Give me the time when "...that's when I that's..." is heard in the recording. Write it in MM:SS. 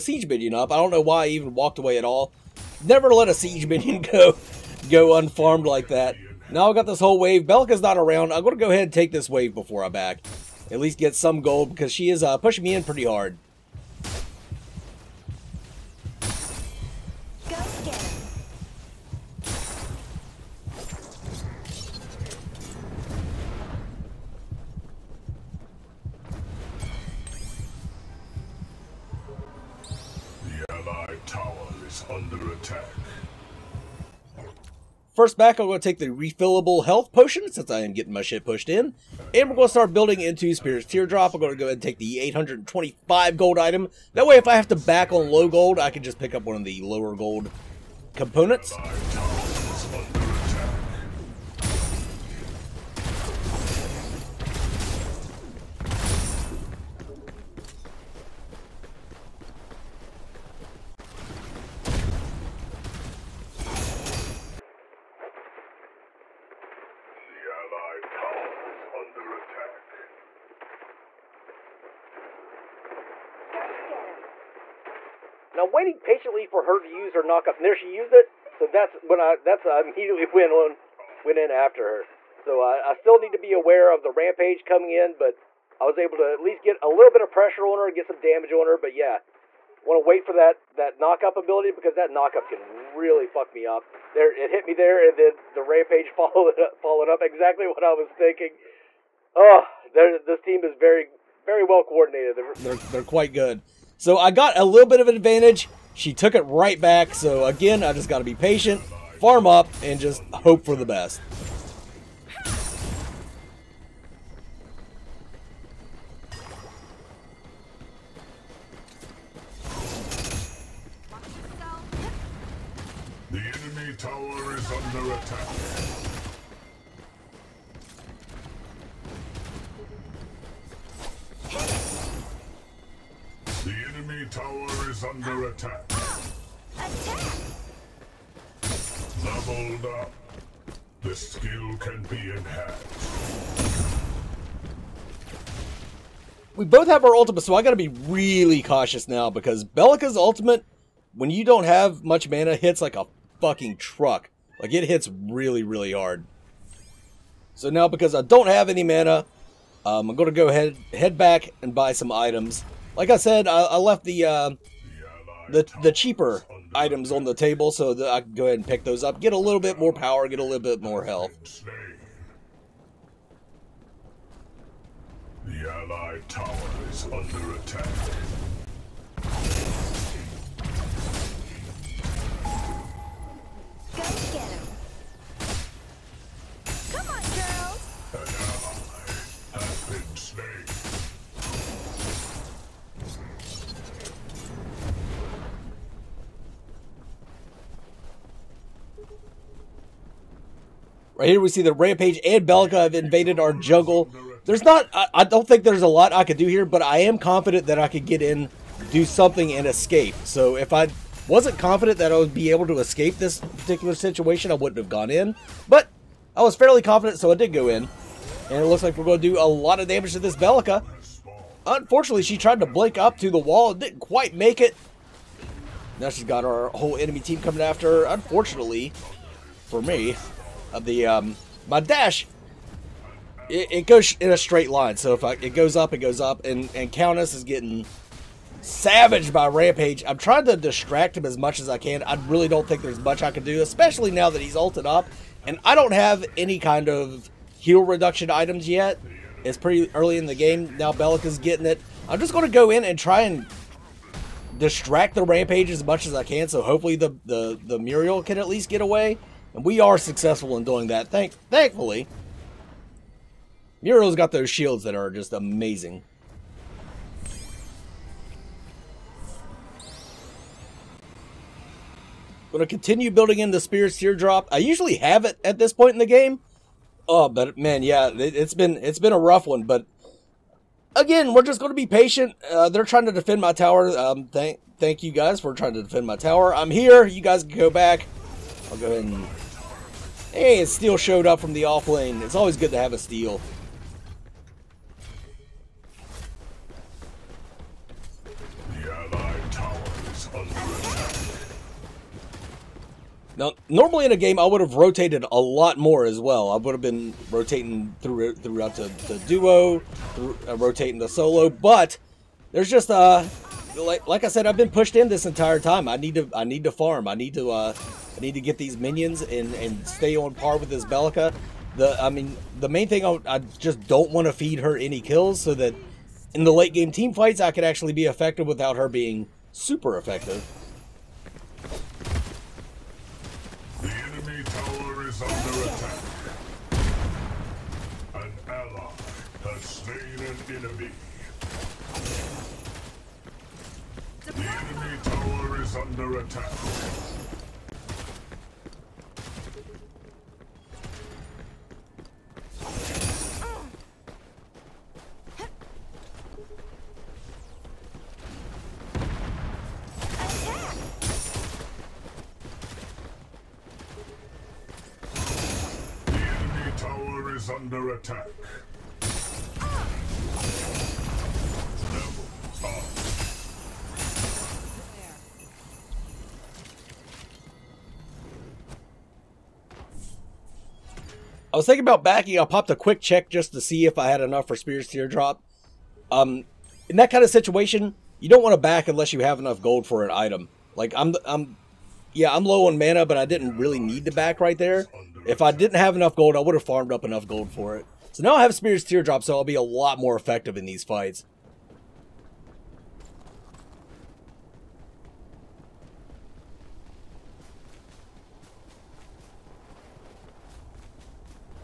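01:18.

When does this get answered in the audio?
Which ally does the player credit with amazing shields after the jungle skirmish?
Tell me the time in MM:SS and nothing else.
04:23.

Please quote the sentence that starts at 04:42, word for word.
Uh, they're trying to defend my tower.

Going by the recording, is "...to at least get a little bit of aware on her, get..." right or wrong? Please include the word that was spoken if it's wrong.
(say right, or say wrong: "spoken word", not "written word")
wrong: "pressure", not "aware".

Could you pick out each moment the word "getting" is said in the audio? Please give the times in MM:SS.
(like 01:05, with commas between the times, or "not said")
00:37, 03:57, 04:11.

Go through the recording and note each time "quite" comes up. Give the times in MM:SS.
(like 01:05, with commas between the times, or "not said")
01:43, 03:44.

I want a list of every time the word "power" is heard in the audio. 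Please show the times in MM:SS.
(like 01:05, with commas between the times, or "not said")
02:49.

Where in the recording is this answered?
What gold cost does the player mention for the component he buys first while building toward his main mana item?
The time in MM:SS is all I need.
00:42.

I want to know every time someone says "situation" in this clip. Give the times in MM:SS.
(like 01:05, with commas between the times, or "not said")
03:33, 06:27.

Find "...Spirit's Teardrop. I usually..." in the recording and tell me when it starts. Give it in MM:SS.
04:33.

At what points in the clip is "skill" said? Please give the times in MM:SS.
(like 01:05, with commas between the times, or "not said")
02:21.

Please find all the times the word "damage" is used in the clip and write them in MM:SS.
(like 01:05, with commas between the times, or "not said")
01:28, 03:39.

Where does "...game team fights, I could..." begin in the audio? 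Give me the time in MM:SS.
05:26.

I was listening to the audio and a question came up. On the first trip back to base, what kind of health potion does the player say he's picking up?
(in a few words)
Refillable health potion.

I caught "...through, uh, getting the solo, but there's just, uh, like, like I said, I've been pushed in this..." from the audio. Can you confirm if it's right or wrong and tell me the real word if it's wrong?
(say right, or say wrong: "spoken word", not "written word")
wrong: "rotating", not "getting".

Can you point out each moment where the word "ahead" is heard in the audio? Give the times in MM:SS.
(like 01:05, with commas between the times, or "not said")
00:08, 00:41, 02:40, 02:48, 04:48.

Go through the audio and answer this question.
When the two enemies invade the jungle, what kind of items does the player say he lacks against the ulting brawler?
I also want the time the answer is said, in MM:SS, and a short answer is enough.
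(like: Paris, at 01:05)
Heal reduction items, at 04:07.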